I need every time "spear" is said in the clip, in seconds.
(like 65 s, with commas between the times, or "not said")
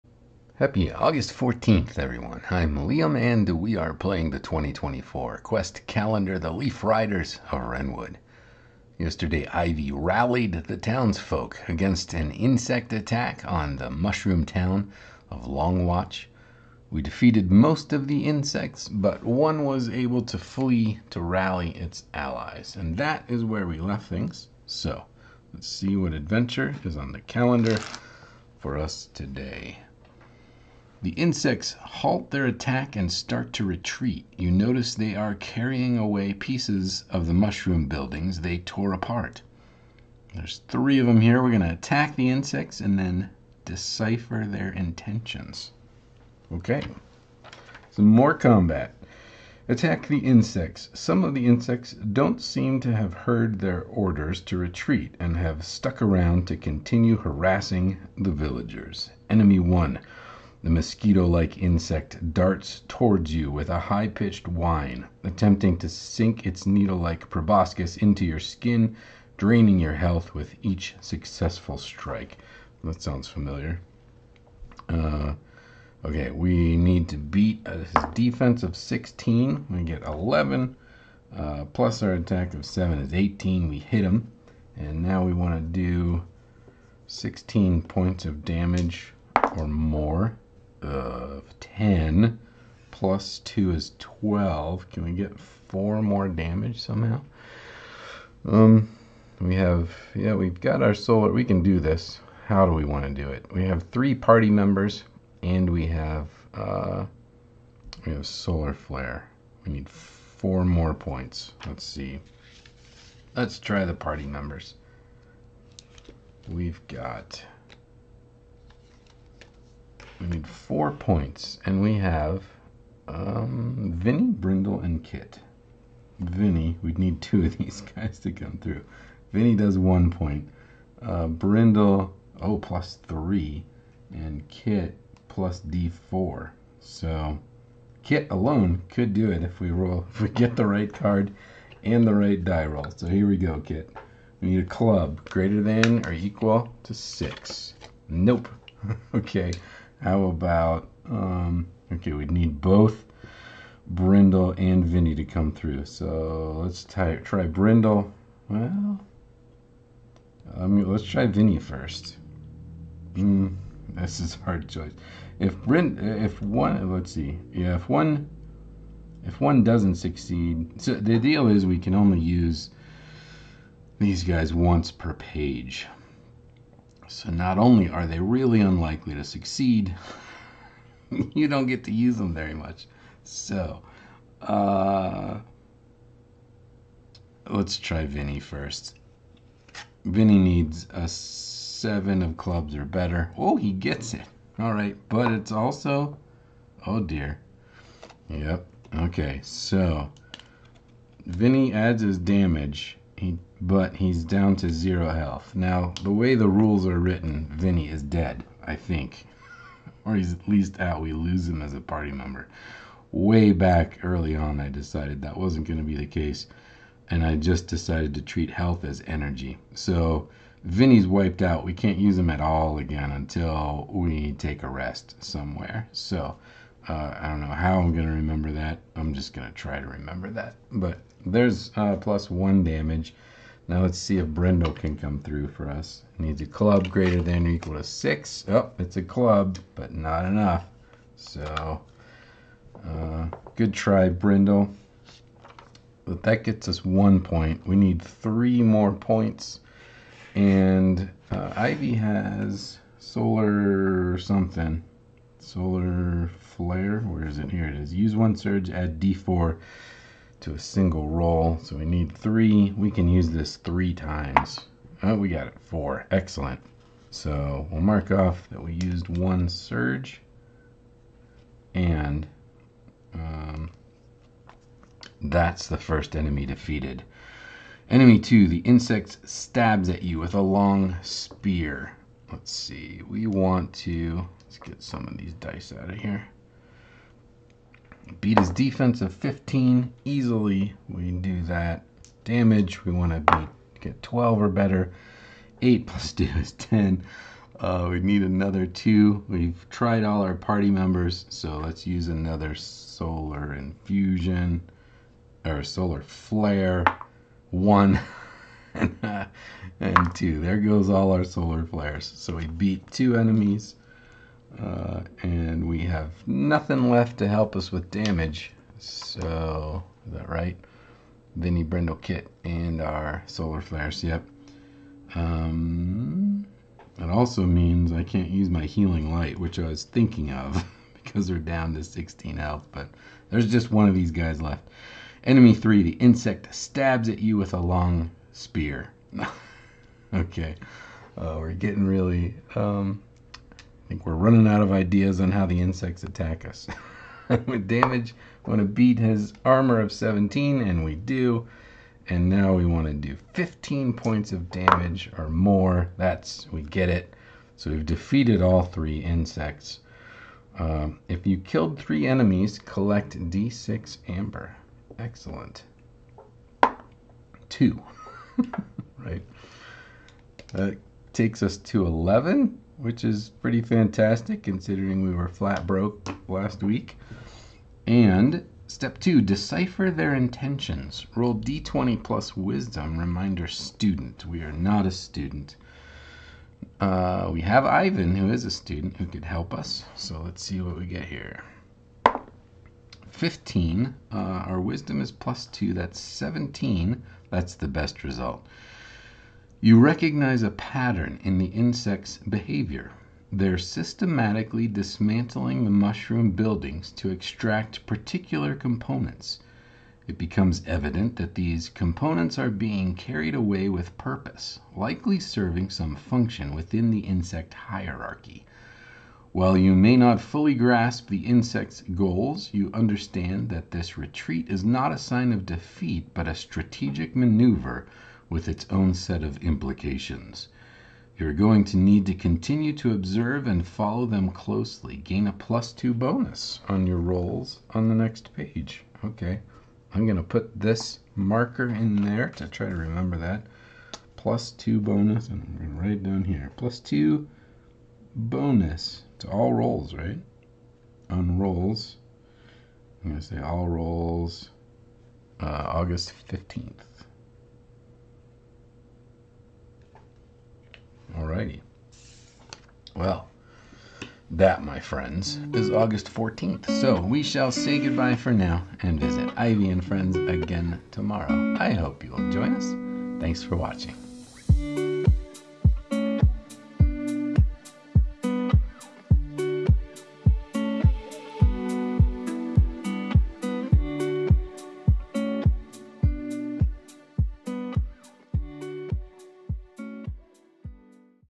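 281 s, 338 s.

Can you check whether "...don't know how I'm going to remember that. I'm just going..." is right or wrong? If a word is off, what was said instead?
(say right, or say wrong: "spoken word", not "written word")
right.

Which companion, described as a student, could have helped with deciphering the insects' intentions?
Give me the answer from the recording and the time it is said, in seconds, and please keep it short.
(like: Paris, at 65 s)
Ivan, at 387 s.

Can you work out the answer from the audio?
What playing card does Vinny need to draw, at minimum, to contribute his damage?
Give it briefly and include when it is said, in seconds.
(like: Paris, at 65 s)
Seven of clubs, at 191 s.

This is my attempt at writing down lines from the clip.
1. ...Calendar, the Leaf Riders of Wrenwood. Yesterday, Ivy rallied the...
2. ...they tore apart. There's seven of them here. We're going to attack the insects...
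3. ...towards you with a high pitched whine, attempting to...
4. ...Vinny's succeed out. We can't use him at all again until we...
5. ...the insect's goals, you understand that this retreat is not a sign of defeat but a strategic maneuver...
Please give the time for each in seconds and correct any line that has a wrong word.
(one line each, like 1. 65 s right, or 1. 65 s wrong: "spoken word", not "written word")
1. 5 s right
2. 38 s wrong: "three", not "seven"
3. 62 s right
4. 220 s wrong: "wiped", not "succeed"
5. 421 s right.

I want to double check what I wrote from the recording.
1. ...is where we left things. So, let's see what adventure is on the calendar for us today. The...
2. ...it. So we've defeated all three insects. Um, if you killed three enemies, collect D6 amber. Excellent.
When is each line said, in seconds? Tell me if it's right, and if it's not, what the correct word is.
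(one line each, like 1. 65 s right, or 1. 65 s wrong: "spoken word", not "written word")
1. 23 s right
2. 356 s right.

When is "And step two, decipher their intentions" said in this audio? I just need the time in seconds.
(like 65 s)
377 s.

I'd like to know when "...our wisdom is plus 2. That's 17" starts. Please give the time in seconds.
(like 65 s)
394 s.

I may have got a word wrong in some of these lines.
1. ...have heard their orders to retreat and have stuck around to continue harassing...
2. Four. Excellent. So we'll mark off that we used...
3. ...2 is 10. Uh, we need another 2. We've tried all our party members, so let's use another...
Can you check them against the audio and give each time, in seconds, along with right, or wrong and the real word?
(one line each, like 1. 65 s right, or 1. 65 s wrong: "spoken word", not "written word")
1. 52 s right
2. 265 s right
3. 296 s right.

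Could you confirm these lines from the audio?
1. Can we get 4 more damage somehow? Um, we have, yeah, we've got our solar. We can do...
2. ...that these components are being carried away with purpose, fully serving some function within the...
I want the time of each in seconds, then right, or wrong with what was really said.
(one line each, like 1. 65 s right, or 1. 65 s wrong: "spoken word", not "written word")
1. 94 s right
2. 411 s wrong: "likely", not "fully".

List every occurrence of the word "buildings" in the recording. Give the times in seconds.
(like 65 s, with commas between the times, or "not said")
37 s, 406 s.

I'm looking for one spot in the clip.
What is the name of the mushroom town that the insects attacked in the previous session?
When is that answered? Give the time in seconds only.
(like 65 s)
15 s.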